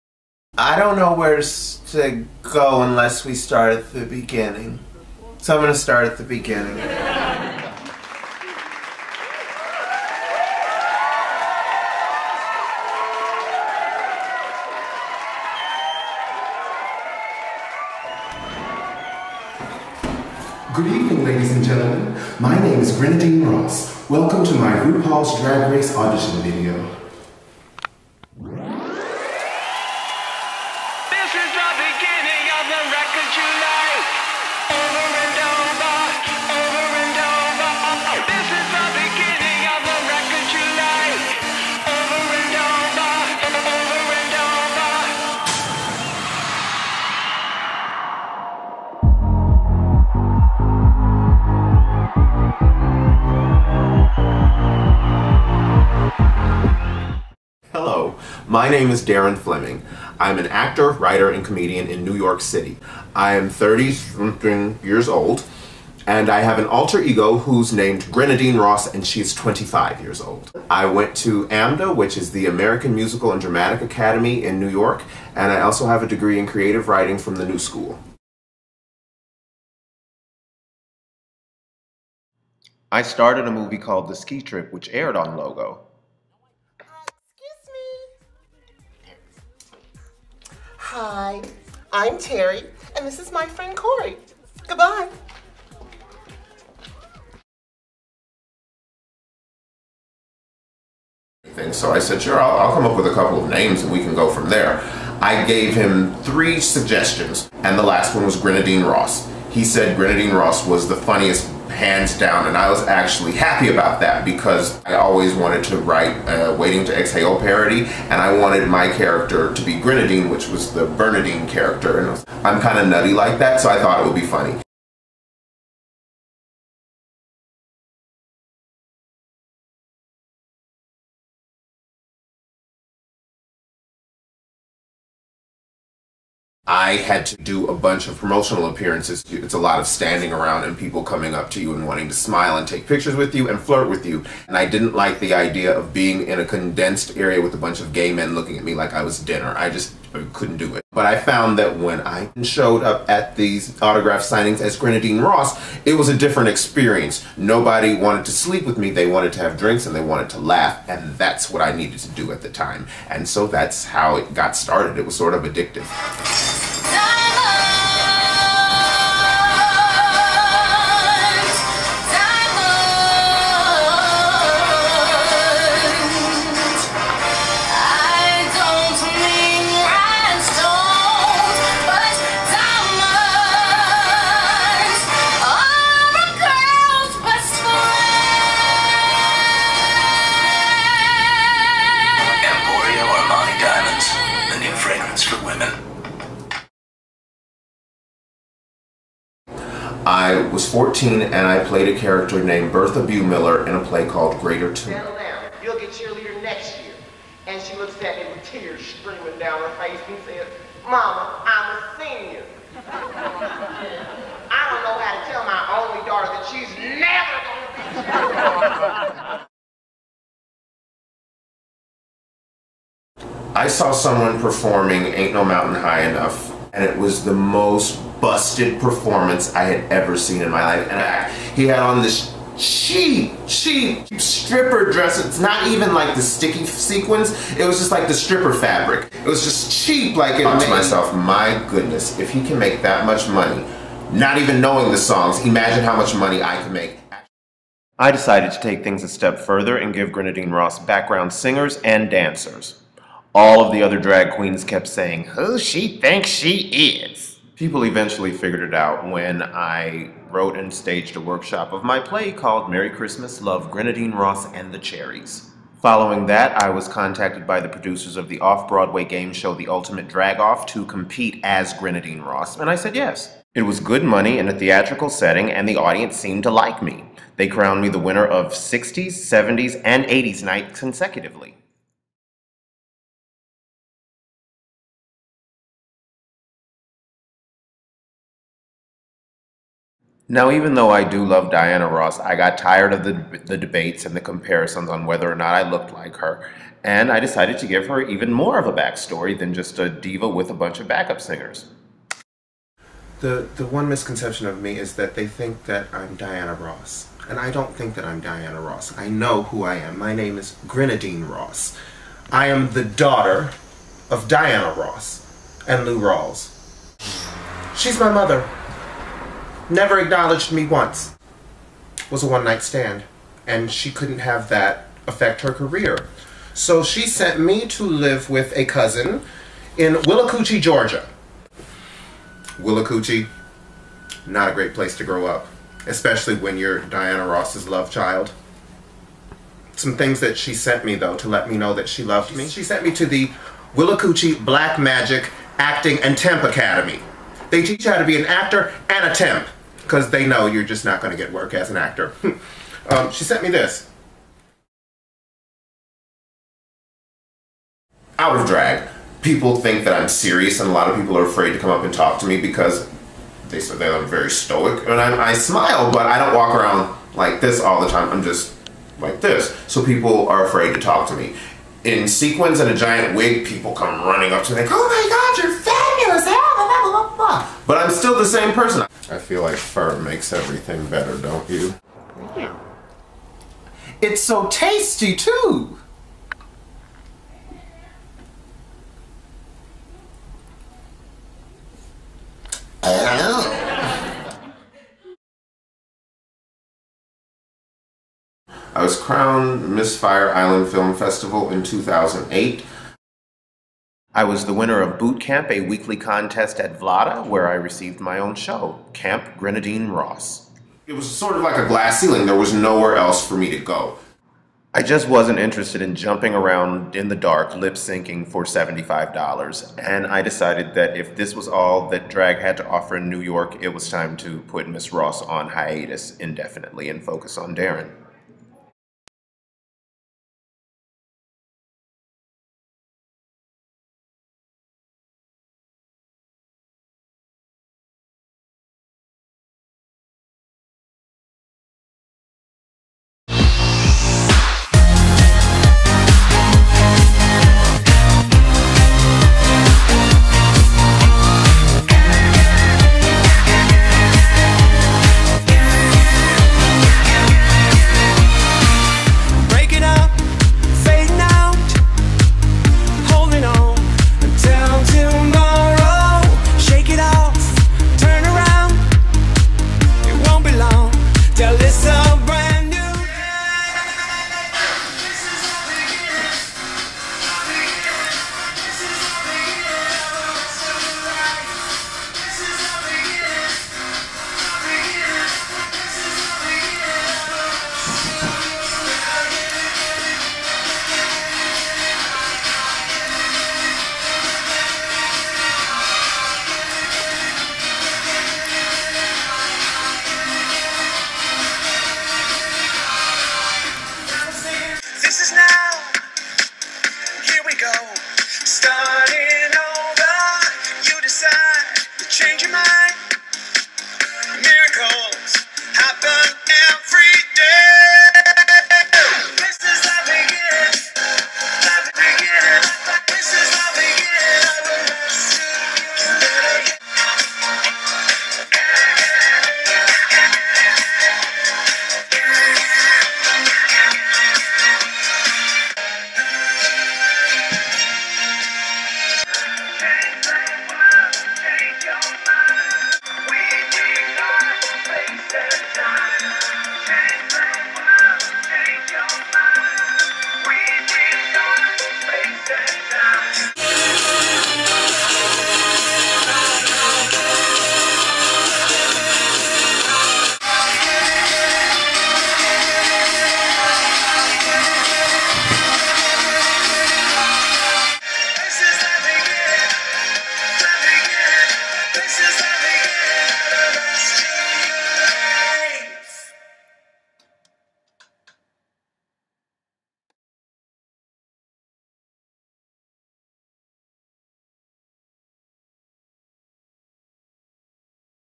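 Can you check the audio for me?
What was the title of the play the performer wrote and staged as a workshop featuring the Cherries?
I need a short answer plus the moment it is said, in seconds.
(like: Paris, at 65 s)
Merry Christmas, Love, Grenadine Ross, at 262 s.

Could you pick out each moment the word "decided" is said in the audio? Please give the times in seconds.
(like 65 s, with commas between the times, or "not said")
248 s, 297 s, 420 s.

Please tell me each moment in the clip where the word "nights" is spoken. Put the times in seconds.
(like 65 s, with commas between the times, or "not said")
280 s, 322 s.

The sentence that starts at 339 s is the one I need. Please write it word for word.
Some things that she sent me, though, to let me know that she loved me.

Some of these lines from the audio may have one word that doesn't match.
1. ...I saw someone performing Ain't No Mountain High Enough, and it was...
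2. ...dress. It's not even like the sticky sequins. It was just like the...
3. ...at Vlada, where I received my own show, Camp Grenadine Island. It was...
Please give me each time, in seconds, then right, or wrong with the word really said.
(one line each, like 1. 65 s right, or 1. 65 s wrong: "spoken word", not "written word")
1. 223 s right
2. 234 s right
3. 406 s wrong: "Ross", not "Island".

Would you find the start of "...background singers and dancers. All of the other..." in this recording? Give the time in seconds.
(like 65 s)
250 s.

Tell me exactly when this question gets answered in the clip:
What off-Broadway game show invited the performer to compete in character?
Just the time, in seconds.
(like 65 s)
269 s.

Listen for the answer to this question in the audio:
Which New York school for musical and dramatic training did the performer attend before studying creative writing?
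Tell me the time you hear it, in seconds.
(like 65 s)
71 s.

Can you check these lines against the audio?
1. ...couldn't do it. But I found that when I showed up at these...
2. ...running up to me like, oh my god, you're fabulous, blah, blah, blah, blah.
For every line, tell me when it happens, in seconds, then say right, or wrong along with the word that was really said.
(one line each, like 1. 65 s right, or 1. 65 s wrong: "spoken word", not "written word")
1. 150 s right
2. 374 s right.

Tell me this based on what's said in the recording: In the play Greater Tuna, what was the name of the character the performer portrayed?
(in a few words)
Bertha Bumiller.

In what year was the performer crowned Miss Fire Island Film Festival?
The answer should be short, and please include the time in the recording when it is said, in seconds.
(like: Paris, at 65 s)
2008, at 401 s.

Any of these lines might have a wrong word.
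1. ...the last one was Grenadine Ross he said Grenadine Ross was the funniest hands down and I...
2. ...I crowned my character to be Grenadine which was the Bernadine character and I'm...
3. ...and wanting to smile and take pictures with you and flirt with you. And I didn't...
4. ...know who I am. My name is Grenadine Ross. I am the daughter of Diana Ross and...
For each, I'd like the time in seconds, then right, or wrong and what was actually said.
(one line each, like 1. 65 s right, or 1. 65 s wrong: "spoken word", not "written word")
1. 107 s right
2. 118 s wrong: "wanted", not "crowned"
3. 141 s right
4. 309 s right.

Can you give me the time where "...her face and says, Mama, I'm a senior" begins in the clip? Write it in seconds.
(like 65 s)
209 s.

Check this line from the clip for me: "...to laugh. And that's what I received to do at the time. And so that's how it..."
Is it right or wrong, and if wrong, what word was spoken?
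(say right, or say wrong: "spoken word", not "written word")
wrong: "needed", not "received".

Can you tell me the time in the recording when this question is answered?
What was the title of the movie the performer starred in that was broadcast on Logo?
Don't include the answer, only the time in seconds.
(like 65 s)
84 s.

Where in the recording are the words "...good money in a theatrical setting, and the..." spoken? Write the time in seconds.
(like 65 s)
273 s.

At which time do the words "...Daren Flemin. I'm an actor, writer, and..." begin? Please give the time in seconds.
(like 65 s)
59 s.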